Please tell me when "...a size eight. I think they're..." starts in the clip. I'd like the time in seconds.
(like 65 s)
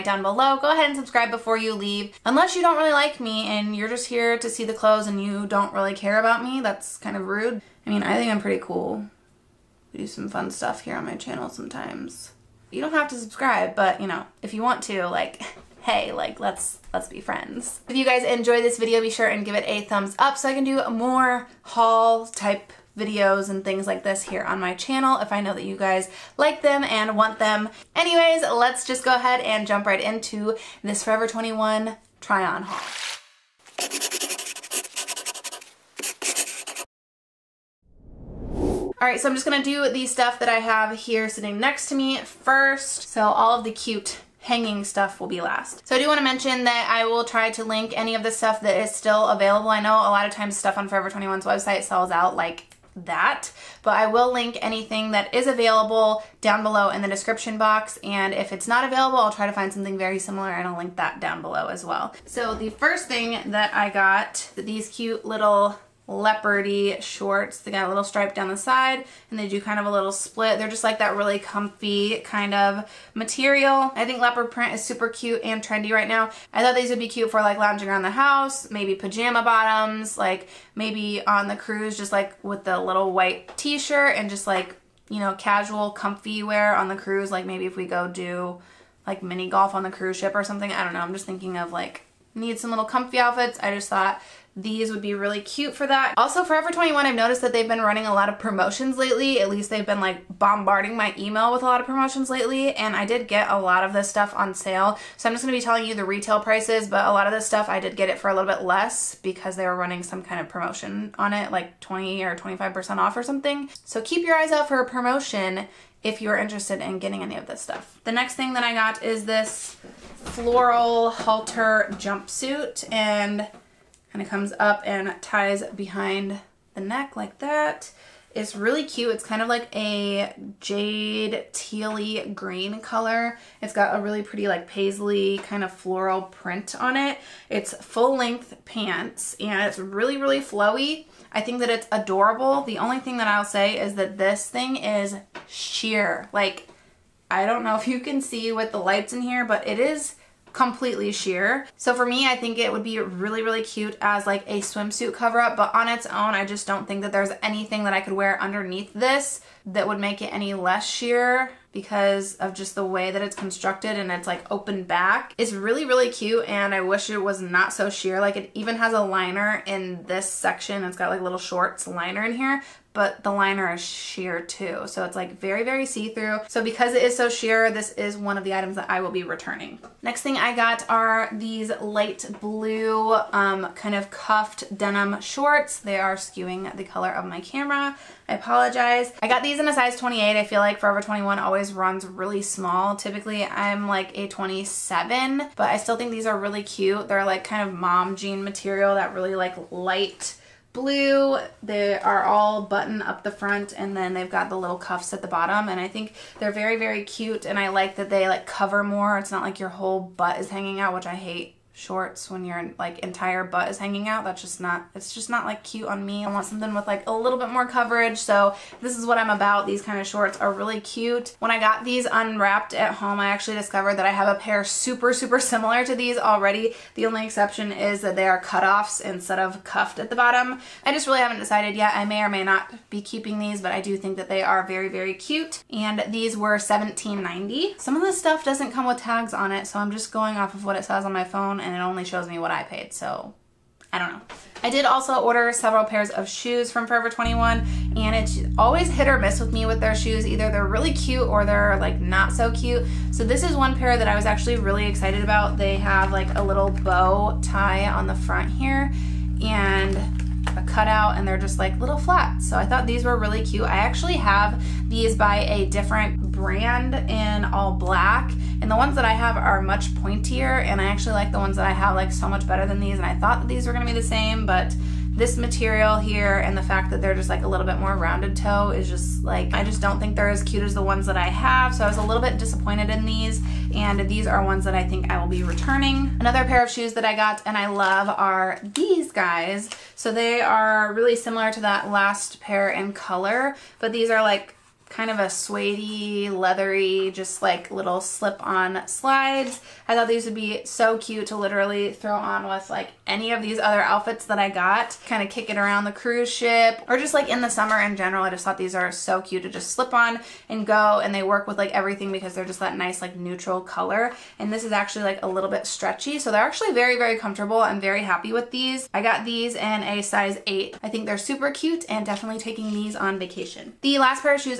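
319 s.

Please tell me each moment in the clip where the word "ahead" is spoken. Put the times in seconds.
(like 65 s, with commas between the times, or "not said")
0 s, 29 s.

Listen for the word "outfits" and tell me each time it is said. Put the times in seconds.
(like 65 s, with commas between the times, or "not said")
93 s, 303 s.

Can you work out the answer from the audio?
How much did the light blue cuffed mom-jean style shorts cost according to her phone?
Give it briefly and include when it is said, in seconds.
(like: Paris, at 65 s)
$17.90, at 236 s.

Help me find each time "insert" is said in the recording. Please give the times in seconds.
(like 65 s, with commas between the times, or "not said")
not said.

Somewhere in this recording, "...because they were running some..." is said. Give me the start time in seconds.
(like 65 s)
109 s.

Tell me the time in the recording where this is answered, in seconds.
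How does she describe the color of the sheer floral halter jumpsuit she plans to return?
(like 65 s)
130 s.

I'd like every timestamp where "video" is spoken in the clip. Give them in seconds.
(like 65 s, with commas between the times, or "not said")
18 s, 22 s.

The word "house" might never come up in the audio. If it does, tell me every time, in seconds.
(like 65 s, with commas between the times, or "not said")
78 s.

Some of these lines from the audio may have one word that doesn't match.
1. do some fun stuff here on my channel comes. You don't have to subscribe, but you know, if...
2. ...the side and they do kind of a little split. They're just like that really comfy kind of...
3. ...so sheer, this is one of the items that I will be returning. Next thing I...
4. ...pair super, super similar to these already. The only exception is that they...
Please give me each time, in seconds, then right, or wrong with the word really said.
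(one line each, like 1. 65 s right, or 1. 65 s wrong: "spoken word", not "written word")
1. 9 s wrong: "sometimes", not "comes"
2. 68 s right
3. 177 s right
4. 224 s right.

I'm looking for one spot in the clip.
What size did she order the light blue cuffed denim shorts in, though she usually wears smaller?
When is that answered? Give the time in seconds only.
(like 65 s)
189 s.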